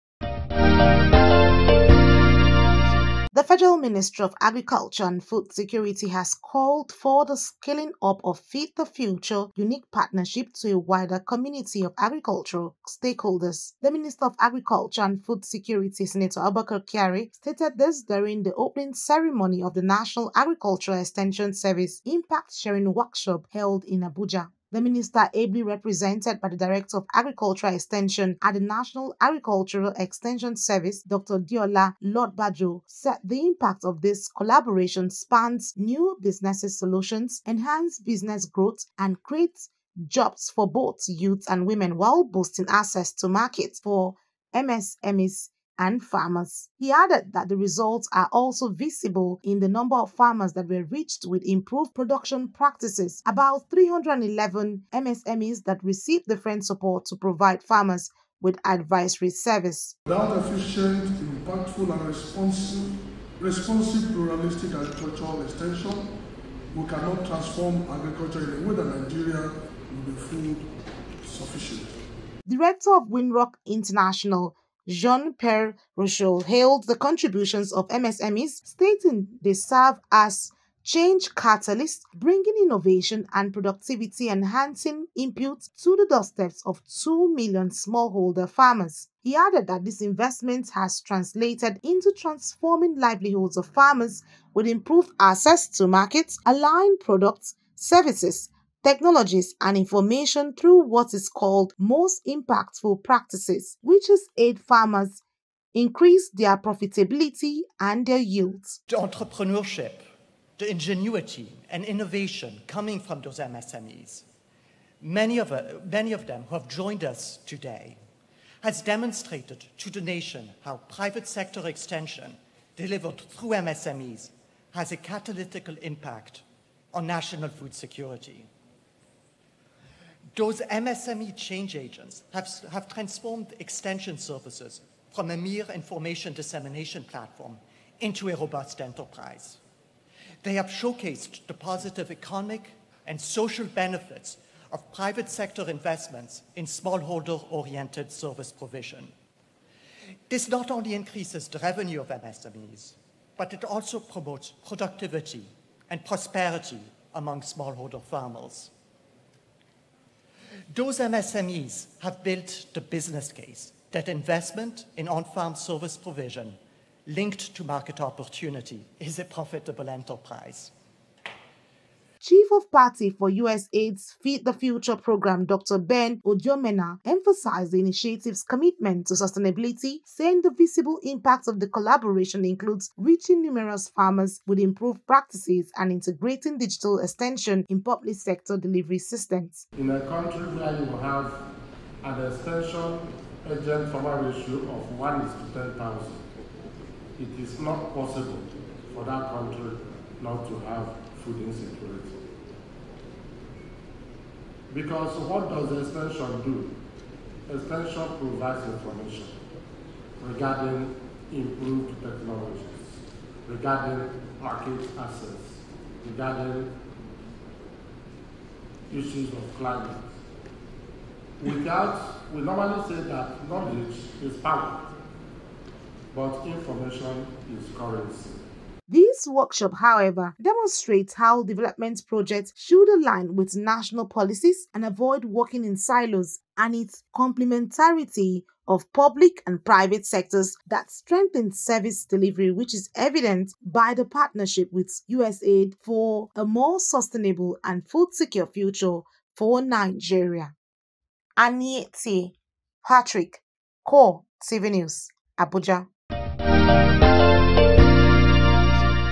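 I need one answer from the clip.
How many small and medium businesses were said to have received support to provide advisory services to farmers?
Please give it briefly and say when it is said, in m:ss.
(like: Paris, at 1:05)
311, at 0:53.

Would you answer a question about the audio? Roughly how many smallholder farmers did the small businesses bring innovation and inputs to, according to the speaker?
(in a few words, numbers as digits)
2 million.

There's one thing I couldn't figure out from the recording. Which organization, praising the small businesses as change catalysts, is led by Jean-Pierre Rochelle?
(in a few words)
Winrock International.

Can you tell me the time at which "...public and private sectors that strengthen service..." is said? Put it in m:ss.
3:58.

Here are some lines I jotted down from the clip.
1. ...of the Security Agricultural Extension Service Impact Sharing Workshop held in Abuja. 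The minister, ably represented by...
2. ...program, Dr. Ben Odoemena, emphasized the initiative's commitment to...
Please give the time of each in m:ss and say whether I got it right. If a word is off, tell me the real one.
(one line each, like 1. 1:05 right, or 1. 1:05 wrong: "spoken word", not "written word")
1. 0:19 wrong: "National", not "Security"
2. 2:54 right.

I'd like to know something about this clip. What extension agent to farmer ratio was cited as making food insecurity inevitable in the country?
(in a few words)
1 to 10,000.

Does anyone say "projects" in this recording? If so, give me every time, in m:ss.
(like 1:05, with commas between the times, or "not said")
3:52.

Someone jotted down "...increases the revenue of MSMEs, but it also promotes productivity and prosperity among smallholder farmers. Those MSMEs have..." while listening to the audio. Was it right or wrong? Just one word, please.
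right.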